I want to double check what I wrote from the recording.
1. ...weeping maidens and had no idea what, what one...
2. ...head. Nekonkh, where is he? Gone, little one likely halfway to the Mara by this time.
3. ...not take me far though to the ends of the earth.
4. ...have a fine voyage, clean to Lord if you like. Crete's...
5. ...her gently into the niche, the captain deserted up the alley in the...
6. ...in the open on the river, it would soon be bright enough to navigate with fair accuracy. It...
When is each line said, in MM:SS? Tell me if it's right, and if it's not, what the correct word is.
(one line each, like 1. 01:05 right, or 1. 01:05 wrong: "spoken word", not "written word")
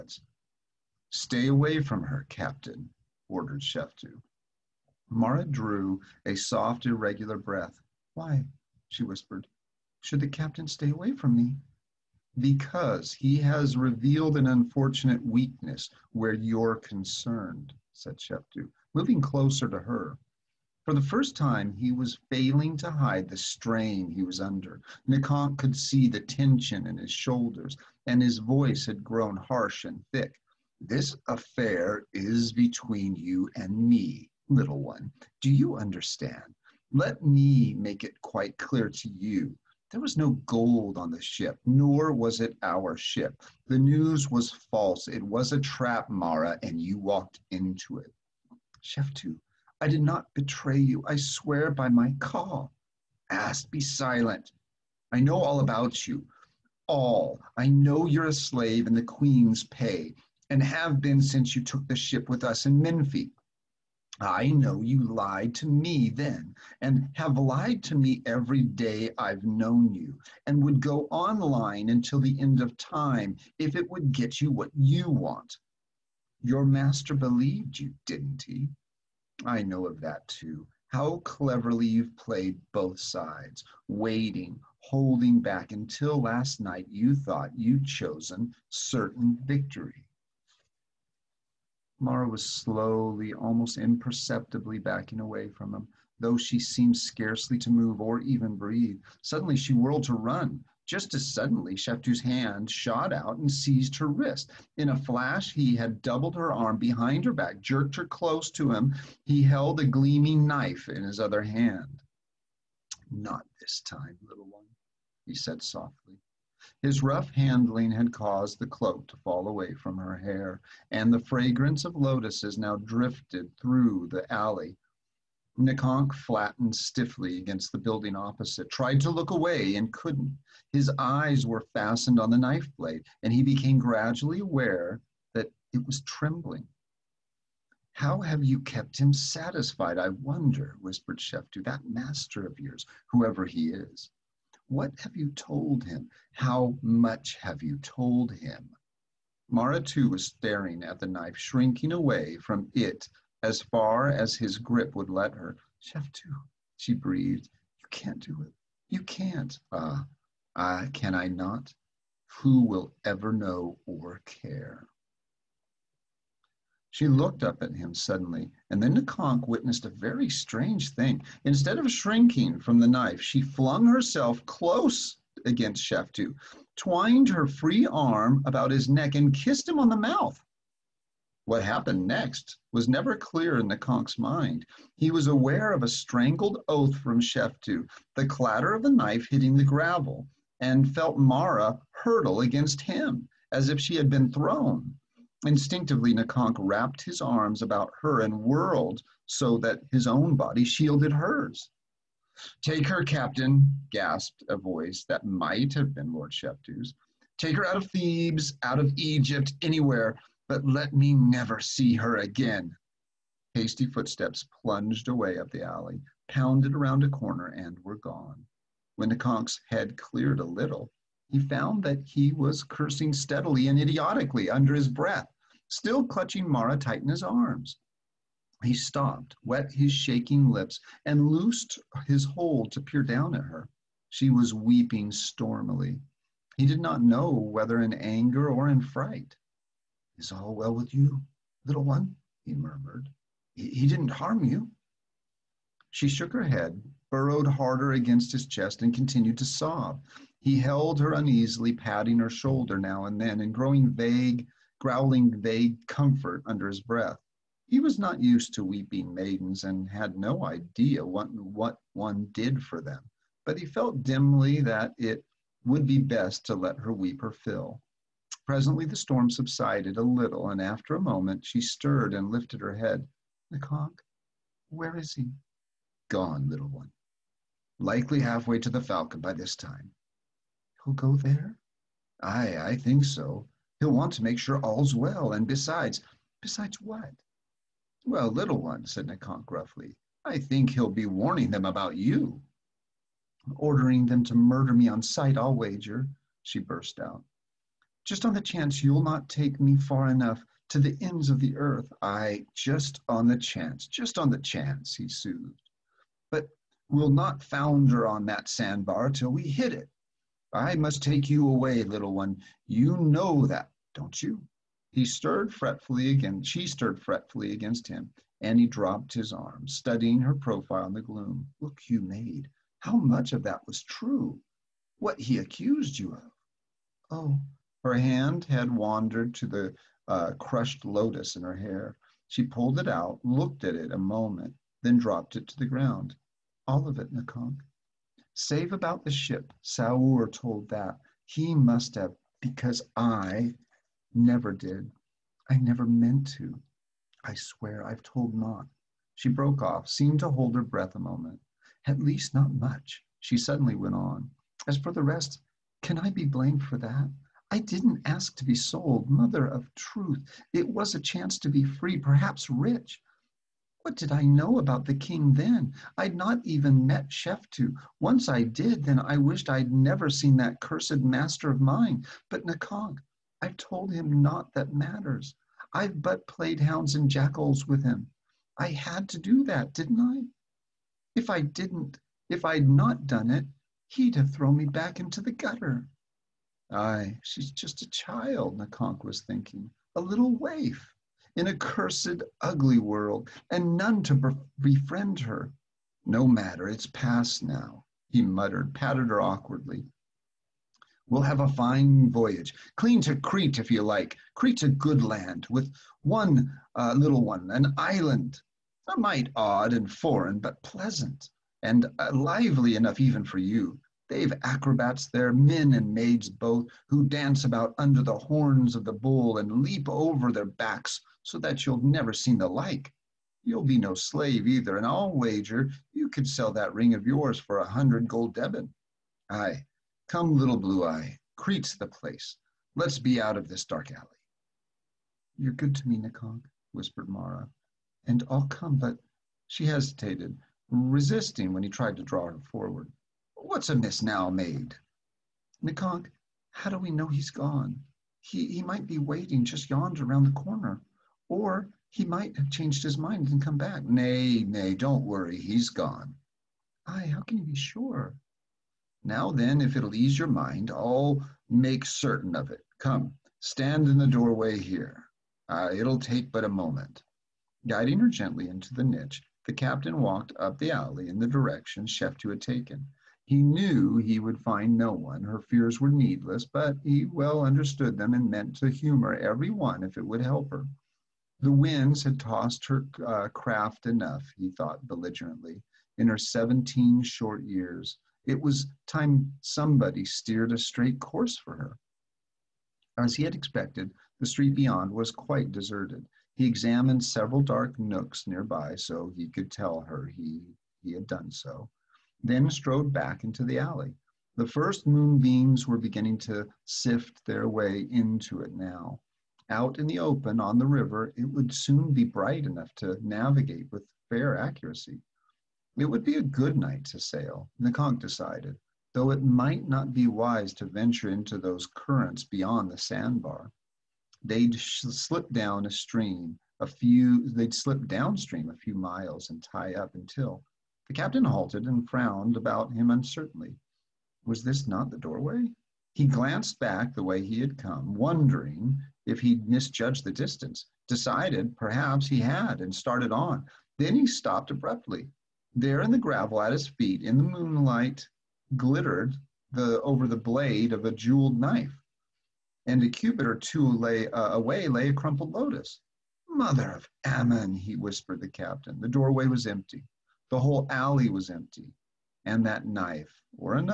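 1. 04:18 right
2. 04:32 wrong: "Falcon", not "Mara"
3. 04:59 wrong: "enough", not "though"
4. 06:41 wrong: "Crete", not "Lord"
5. 07:47 wrong: "walked", not "deserted"
6. 08:29 right.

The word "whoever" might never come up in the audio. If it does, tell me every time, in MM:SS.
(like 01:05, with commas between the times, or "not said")
02:23.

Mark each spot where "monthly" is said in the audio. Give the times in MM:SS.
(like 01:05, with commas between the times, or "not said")
not said.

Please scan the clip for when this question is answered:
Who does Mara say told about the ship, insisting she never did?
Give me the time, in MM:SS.
05:39.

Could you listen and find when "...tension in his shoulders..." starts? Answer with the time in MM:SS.
00:26.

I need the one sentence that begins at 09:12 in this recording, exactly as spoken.
And a cubit or two lay, uh, away lay a crumpled lotus.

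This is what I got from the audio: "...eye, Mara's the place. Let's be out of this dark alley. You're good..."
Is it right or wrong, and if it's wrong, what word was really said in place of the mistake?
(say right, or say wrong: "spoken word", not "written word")
wrong: "Crete", not "Mara".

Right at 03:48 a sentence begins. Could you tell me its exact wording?
He stopped, wet his shaking lips, and loosed his hold to peer down at her.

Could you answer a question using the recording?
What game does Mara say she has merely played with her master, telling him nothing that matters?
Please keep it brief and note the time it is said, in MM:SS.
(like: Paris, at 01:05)
Hounds and jackals, at 06:16.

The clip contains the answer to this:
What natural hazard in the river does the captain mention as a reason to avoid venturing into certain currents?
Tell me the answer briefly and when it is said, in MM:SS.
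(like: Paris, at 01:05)
The sandbar, at 08:42.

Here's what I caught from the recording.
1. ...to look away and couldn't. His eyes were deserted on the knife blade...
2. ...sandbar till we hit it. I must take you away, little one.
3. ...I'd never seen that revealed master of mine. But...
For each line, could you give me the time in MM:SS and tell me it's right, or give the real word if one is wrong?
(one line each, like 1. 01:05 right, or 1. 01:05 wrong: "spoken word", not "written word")
1. 02:09 wrong: "fastened", not "deserted"
2. 05:08 right
3. 06:09 wrong: "cursed", not "revealed".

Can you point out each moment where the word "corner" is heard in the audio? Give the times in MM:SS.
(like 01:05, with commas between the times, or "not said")
03:37, 07:30.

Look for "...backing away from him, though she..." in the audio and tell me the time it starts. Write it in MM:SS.
01:34.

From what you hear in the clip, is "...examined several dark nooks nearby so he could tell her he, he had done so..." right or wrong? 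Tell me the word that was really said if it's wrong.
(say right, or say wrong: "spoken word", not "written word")
right.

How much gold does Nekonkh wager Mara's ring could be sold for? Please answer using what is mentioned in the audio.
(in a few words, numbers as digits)
100 gold deben.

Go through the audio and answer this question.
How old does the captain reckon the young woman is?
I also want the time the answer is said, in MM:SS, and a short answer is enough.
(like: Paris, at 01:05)
17, at 08:06.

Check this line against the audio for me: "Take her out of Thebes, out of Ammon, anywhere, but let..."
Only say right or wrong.
wrong.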